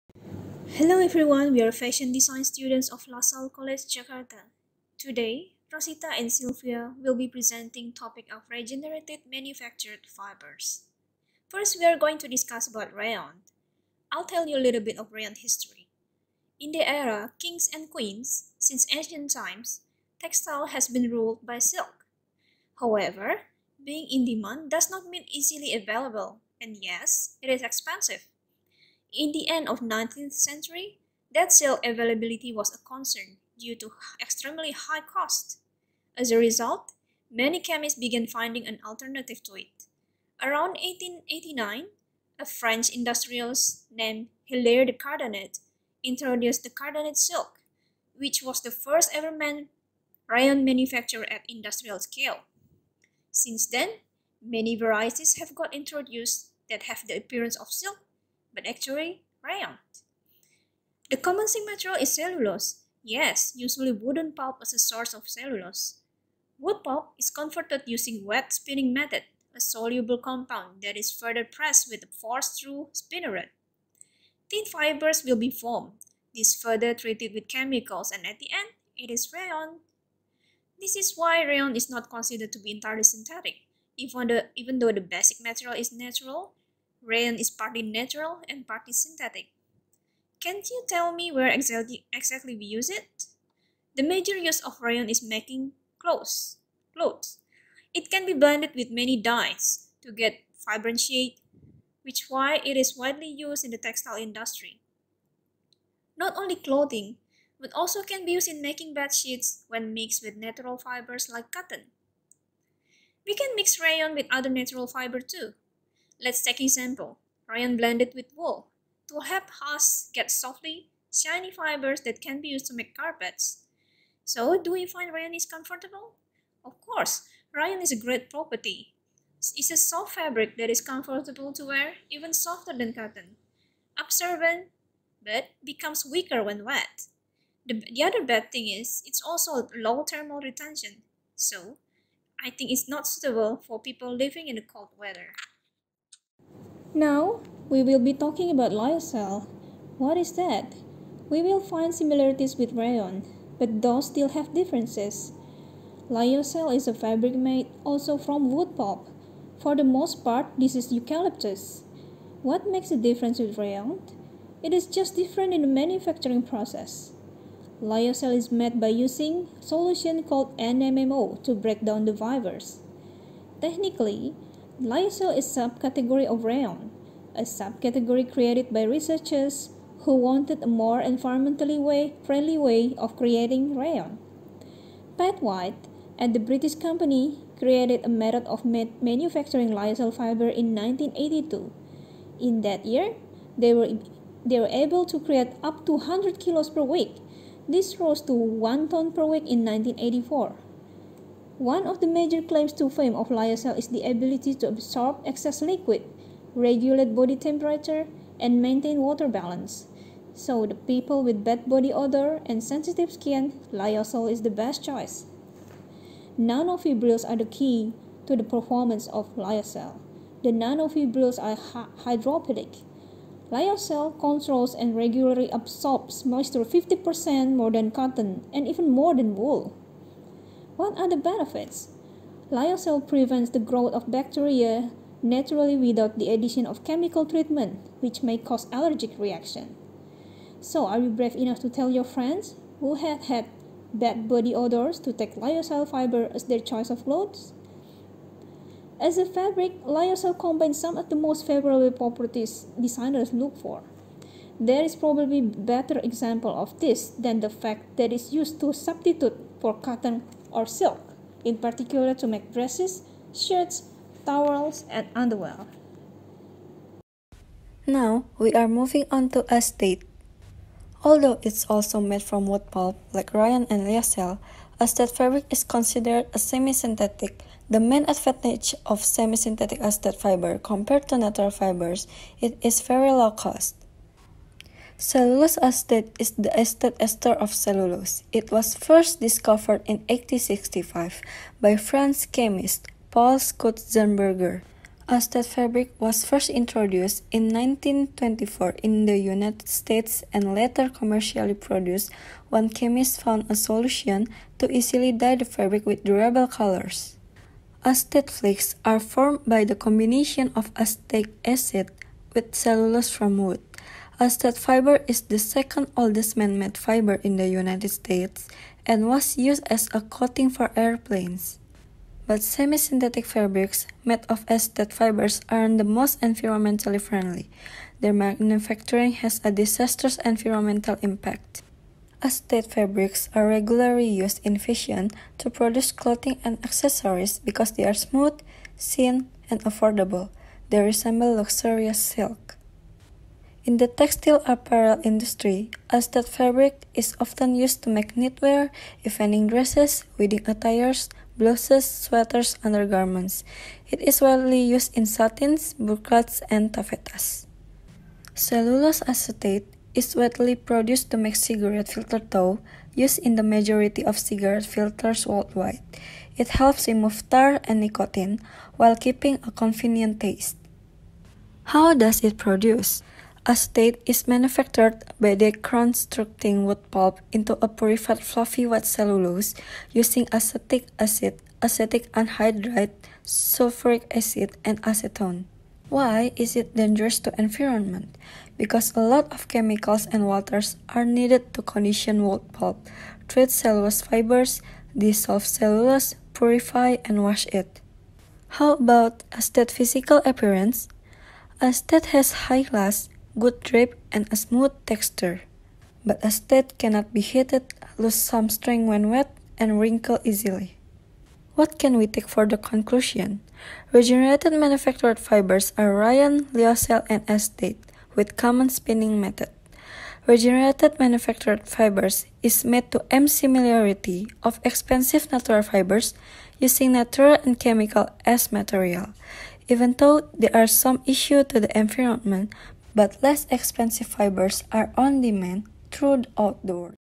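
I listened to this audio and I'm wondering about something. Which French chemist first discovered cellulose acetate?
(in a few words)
Paul Schutzenberger.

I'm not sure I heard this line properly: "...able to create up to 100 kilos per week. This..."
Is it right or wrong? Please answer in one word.
right.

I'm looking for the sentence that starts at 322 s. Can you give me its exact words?
But semi-synthetic fabrics made of acetate fibers aren't the most environmentally friendly.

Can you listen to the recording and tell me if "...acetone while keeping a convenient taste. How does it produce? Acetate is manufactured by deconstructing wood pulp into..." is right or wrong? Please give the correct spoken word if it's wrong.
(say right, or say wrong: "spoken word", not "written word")
wrong: "nicotine", not "acetone".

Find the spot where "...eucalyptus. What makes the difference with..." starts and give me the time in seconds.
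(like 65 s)
160 s.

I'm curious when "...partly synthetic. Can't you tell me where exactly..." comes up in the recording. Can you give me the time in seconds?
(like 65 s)
88 s.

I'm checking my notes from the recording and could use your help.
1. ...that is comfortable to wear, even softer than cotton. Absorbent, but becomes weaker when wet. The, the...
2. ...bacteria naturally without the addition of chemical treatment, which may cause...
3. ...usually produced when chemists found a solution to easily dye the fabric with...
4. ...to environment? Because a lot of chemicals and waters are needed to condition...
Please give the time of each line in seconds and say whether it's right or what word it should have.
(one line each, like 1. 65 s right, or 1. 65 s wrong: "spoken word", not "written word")
1. 130 s right
2. 234 s right
3. 300 s wrong: "commercially", not "usually"
4. 387 s right.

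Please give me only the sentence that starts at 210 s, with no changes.
So the people with bad body odor and sensitive skin, lyocell is the best choice.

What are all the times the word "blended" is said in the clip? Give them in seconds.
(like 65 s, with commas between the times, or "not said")
98 s, 117 s.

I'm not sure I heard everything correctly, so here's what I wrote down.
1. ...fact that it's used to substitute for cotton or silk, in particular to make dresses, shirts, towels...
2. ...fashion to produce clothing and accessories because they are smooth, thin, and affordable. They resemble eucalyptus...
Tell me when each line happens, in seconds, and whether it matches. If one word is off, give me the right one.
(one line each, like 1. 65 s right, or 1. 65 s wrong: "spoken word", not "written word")
1. 257 s right
2. 334 s wrong: "luxurious", not "eucalyptus".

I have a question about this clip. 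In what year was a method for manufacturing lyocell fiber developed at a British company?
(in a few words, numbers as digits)
1982.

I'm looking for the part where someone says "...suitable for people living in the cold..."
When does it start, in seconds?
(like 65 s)
143 s.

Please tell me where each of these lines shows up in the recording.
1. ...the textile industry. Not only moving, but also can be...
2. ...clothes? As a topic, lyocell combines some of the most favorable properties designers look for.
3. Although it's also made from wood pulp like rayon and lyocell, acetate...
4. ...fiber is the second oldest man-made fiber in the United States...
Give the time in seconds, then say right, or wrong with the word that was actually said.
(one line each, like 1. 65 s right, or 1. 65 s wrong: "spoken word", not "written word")
1. 103 s wrong: "clothing", not "moving"
2. 247 s wrong: "fabric", not "topic"
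3. 271 s right
4. 314 s right.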